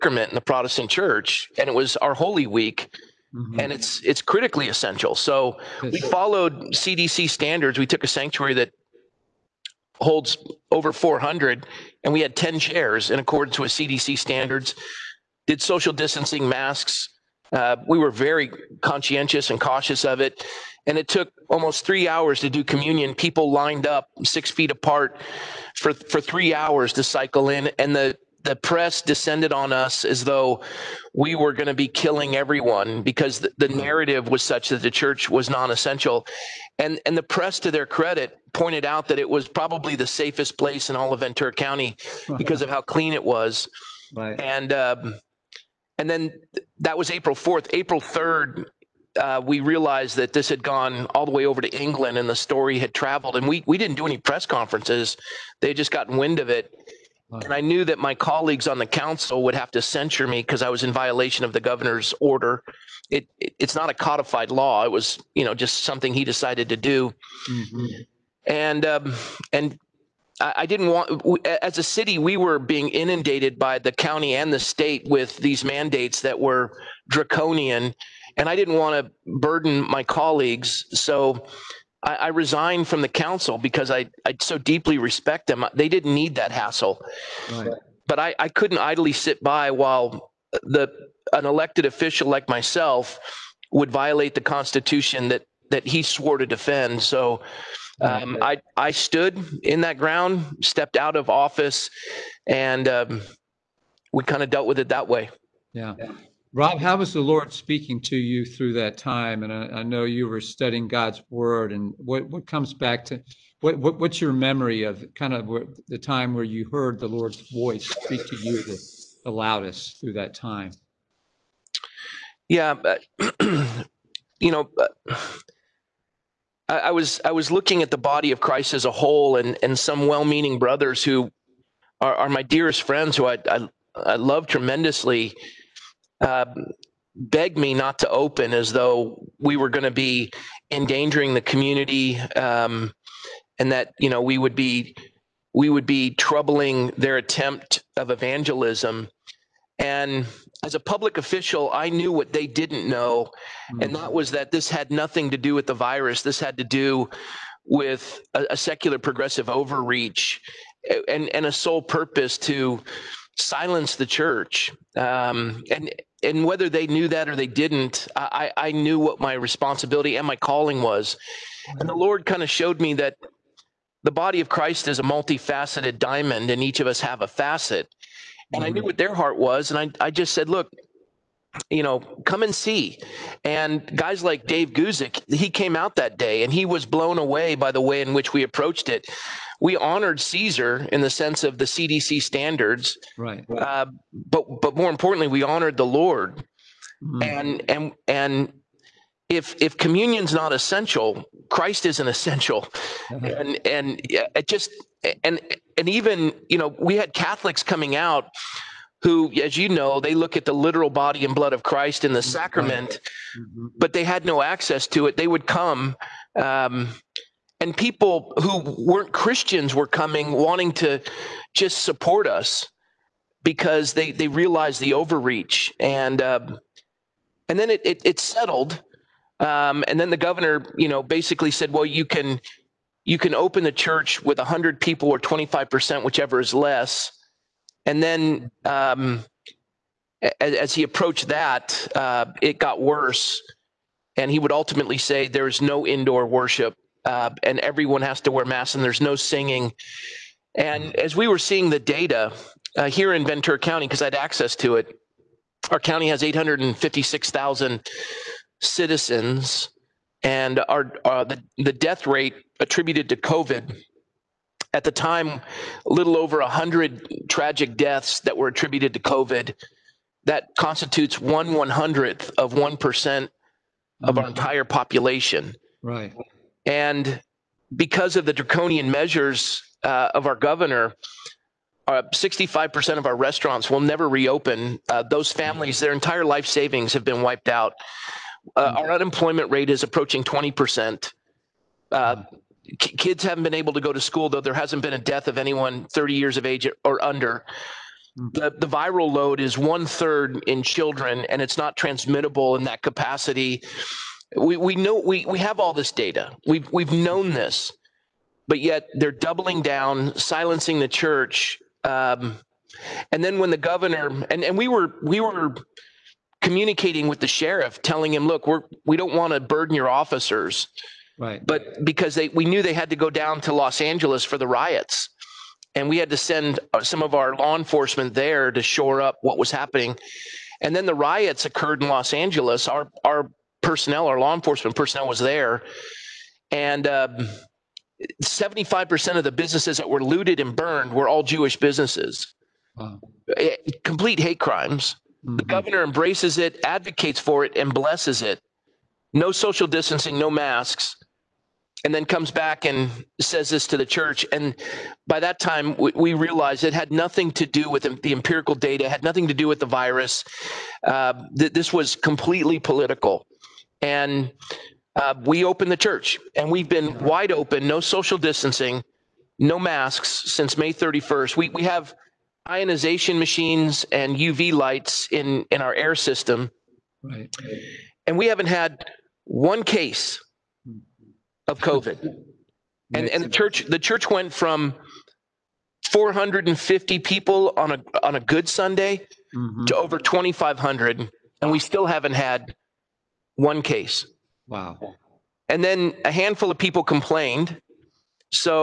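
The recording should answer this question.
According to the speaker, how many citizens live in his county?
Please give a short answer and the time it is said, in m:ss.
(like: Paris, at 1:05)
856,000, at 4:16.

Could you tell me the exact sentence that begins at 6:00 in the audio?
Uh, th- this was completely political.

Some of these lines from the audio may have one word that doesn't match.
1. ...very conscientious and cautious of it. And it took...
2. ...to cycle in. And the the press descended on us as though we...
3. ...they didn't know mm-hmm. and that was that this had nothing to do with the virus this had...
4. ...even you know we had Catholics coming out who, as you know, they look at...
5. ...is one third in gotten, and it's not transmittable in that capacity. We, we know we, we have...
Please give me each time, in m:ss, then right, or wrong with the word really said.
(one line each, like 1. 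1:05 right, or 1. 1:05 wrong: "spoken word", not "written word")
1. 0:18 right
2. 0:26 right
3. 2:32 right
4. 3:25 right
5. 4:59 wrong: "children", not "gotten".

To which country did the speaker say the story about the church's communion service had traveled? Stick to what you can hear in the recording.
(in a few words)
England.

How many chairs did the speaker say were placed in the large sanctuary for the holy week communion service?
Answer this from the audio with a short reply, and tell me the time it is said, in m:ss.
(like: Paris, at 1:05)
10, at 0:12.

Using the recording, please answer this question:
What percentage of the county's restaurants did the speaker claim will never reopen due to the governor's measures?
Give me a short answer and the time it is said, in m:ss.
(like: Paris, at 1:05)
65%, at 4:42.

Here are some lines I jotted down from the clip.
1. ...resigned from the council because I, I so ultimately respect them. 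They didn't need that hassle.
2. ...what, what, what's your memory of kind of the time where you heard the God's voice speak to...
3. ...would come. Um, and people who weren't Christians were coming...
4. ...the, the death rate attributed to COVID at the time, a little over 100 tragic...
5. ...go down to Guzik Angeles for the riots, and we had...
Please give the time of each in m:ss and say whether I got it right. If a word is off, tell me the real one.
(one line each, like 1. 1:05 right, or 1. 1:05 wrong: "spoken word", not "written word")
1. 1:22 wrong: "deeply", not "ultimately"
2. 1:53 wrong: "Lord", not "God"
3. 3:35 right
4. 4:21 right
5. 5:22 wrong: "Los", not "Guzik".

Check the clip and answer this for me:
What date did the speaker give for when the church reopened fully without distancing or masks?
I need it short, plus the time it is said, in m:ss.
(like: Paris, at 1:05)
May 31st, at 6:10.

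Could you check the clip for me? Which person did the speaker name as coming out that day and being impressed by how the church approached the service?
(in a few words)
Dave Guzik.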